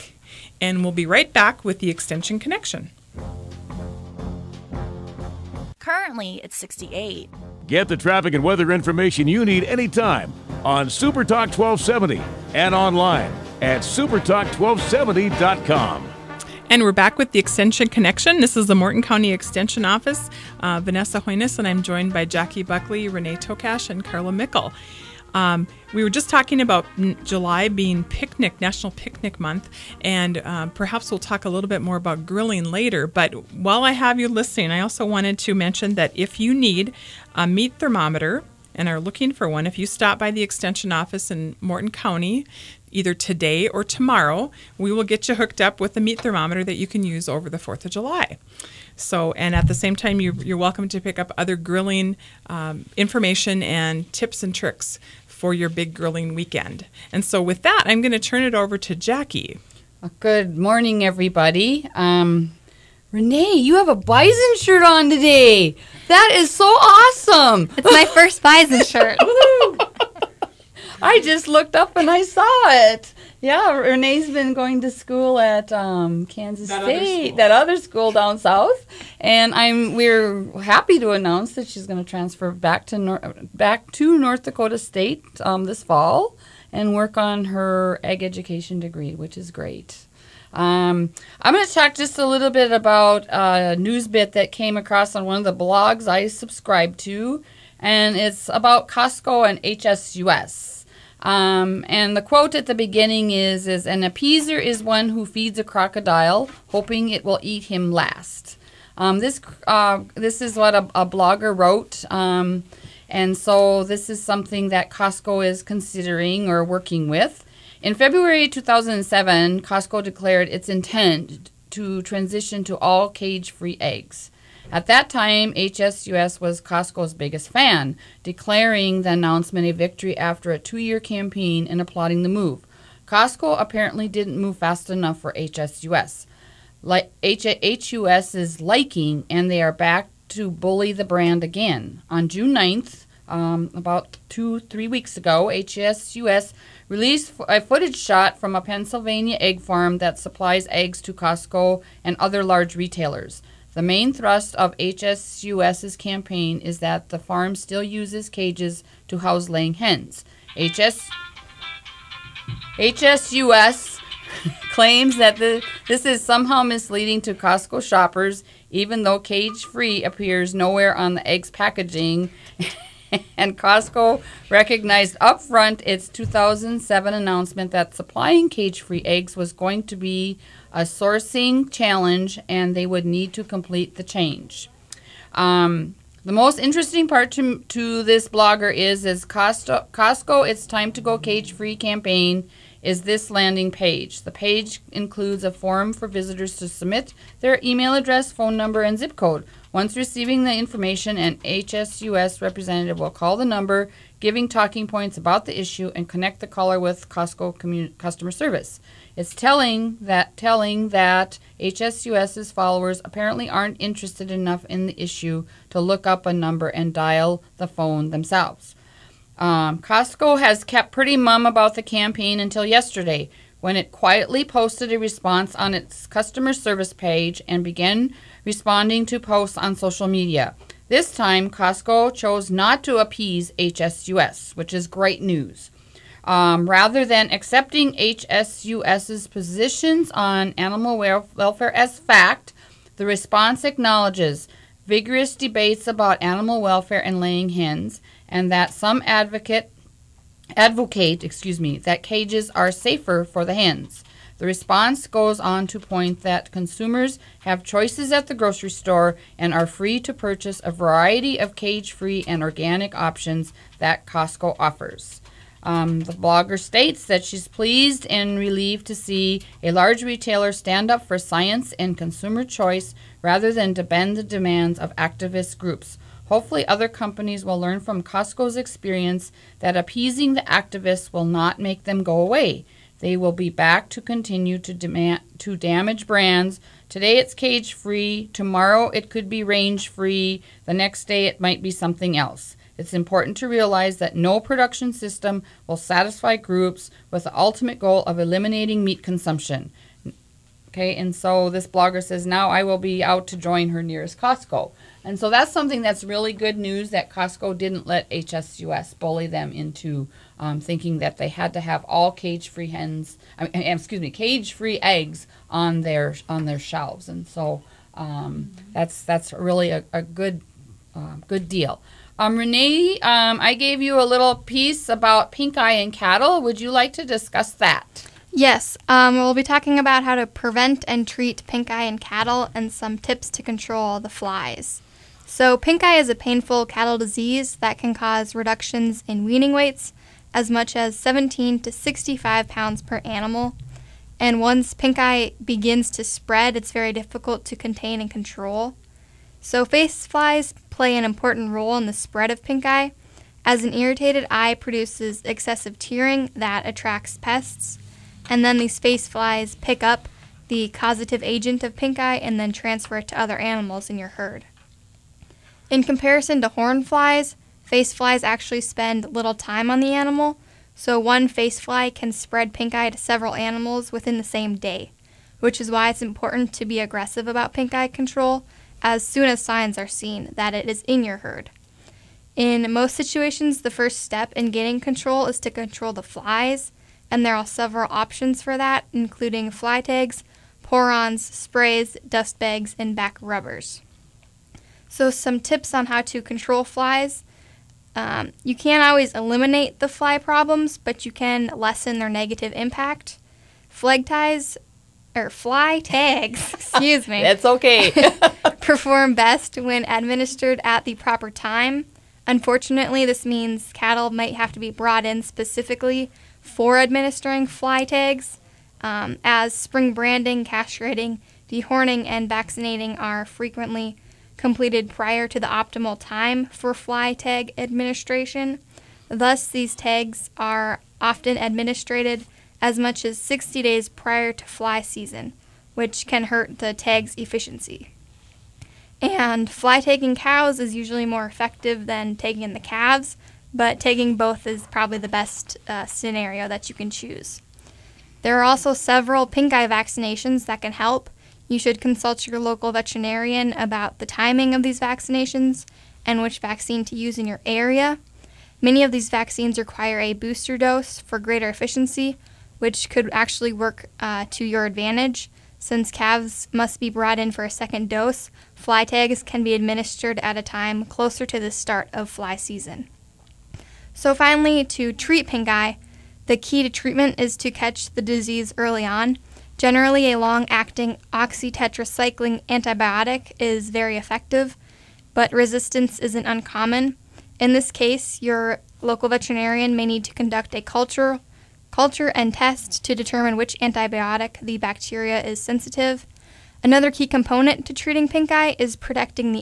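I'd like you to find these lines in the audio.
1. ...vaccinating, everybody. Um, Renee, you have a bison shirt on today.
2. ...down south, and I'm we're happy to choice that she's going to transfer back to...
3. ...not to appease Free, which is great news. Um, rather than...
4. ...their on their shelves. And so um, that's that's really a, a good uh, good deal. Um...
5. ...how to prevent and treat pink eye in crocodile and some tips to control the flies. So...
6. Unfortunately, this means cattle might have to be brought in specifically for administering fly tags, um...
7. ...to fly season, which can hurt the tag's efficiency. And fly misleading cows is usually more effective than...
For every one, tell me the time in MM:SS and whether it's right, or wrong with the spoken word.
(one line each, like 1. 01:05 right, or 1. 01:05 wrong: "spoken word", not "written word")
1. 01:00 wrong: "morning", not "vaccinating"
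2. 01:18 wrong: "announce", not "choice"
3. 03:52 wrong: "HSUS", not "Free"
4. 05:15 right
5. 05:30 wrong: "cattle", not "crocodile"
6. 06:52 right
7. 07:14 wrong: "tagging", not "misleading".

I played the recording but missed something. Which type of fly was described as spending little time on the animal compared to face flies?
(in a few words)
horn flies.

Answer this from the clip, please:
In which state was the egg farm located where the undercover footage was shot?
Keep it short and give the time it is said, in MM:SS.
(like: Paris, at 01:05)
Pennsylvania, at 02:28.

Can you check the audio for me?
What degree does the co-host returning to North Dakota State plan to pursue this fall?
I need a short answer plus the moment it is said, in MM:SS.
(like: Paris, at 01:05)
ag education, at 01:28.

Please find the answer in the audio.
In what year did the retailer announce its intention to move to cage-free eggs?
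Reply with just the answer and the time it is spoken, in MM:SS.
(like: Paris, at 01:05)
2007, at 01:57.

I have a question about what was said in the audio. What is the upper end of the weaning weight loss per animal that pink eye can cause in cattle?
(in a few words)
65 pounds.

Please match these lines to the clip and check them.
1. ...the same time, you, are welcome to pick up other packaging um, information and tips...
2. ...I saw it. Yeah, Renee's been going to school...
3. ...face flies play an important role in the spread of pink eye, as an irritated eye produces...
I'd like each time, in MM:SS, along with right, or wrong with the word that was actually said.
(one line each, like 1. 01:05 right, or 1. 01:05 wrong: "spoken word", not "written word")
1. 00:49 wrong: "grilling", not "packaging"
2. 01:12 right
3. 05:49 right.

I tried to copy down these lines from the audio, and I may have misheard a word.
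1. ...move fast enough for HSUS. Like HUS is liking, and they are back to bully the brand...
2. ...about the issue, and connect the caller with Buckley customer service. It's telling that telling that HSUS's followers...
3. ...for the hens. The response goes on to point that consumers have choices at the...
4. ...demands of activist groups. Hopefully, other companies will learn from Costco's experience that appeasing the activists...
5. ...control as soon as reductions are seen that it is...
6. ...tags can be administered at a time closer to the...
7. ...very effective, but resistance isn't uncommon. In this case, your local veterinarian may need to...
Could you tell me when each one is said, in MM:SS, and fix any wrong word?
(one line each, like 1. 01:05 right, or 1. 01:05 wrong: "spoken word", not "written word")
1. 02:14 right
2. 03:25 wrong: "Costco", not "Buckley"
3. 04:13 right
4. 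04:34 right
5. 06:17 wrong: "signs", not "reductions"
6. 07:48 right
7. 08:03 right.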